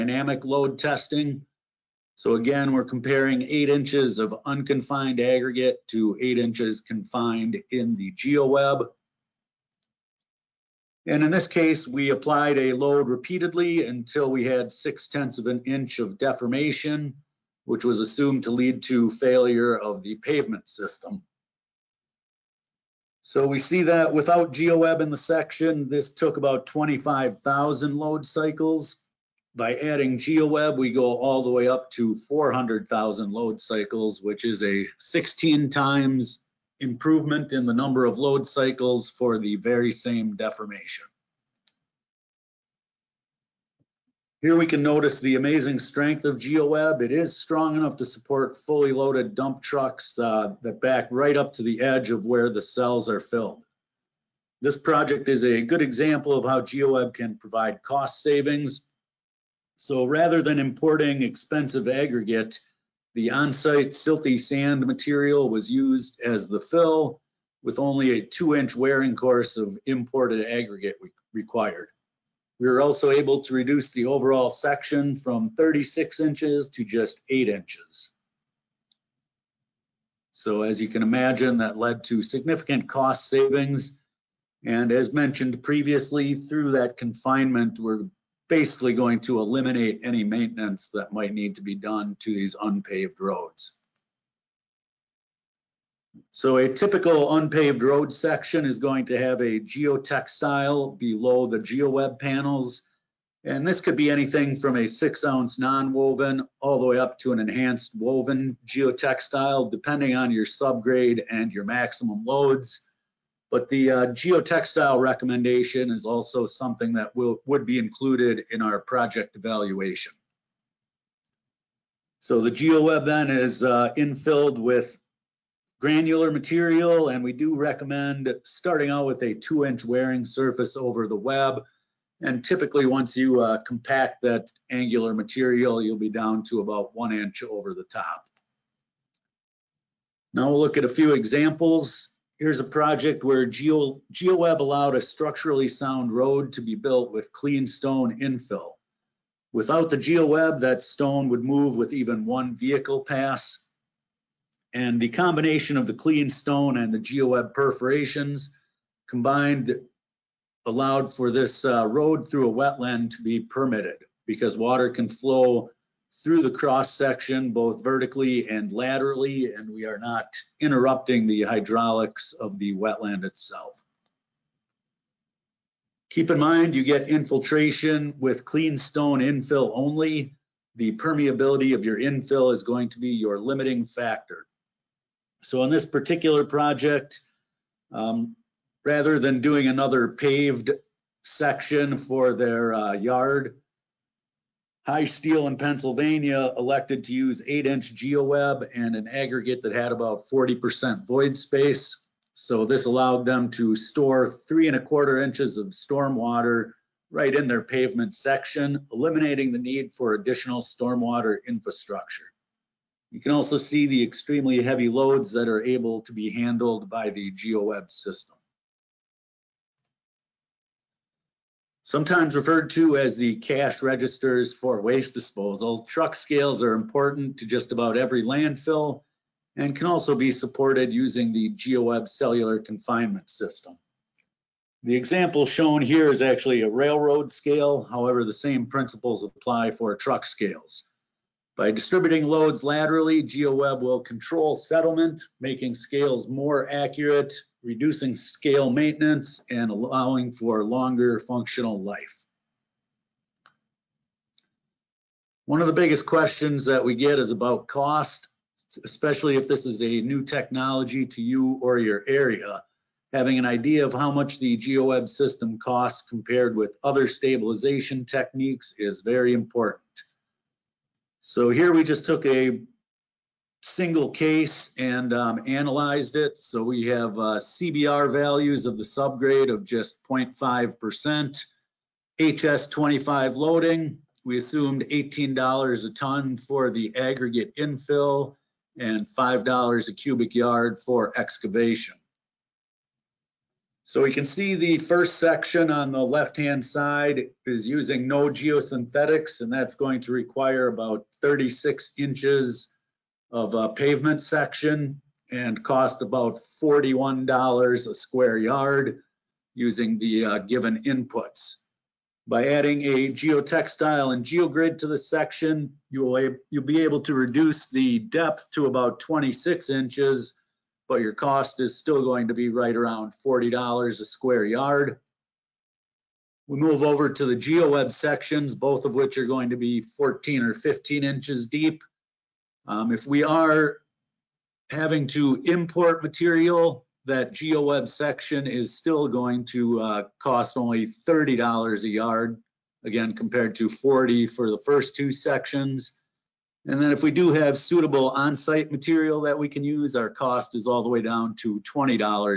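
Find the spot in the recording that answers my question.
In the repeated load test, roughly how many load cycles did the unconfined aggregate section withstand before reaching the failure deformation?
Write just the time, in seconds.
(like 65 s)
26 s.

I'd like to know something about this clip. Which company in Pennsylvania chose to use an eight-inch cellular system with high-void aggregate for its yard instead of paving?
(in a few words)
High Steel.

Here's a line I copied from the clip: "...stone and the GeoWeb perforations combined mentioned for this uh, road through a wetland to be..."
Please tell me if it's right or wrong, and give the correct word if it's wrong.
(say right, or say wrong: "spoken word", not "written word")
wrong: "allowed", not "mentioned".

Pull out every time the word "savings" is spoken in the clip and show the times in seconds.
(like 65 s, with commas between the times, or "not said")
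58 s, 83 s.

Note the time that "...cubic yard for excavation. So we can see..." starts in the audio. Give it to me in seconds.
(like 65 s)
289 s.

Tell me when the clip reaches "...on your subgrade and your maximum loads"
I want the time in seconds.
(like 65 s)
110 s.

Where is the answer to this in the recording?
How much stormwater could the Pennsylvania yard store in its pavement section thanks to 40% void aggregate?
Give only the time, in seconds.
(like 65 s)
204 s.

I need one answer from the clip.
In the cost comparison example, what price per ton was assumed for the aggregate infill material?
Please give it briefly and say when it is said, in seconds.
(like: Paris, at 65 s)
$18, at 284 s.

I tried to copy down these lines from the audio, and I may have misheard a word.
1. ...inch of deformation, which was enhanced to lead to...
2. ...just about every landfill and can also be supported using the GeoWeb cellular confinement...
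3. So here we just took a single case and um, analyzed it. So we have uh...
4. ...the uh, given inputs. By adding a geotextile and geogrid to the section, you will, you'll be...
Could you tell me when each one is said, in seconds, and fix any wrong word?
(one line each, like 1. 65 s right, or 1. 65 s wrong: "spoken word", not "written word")
1. 15 s wrong: "assumed", not "enhanced"
2. 227 s right
3. 271 s right
4. 309 s right.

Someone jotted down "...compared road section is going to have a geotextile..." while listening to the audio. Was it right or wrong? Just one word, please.
wrong.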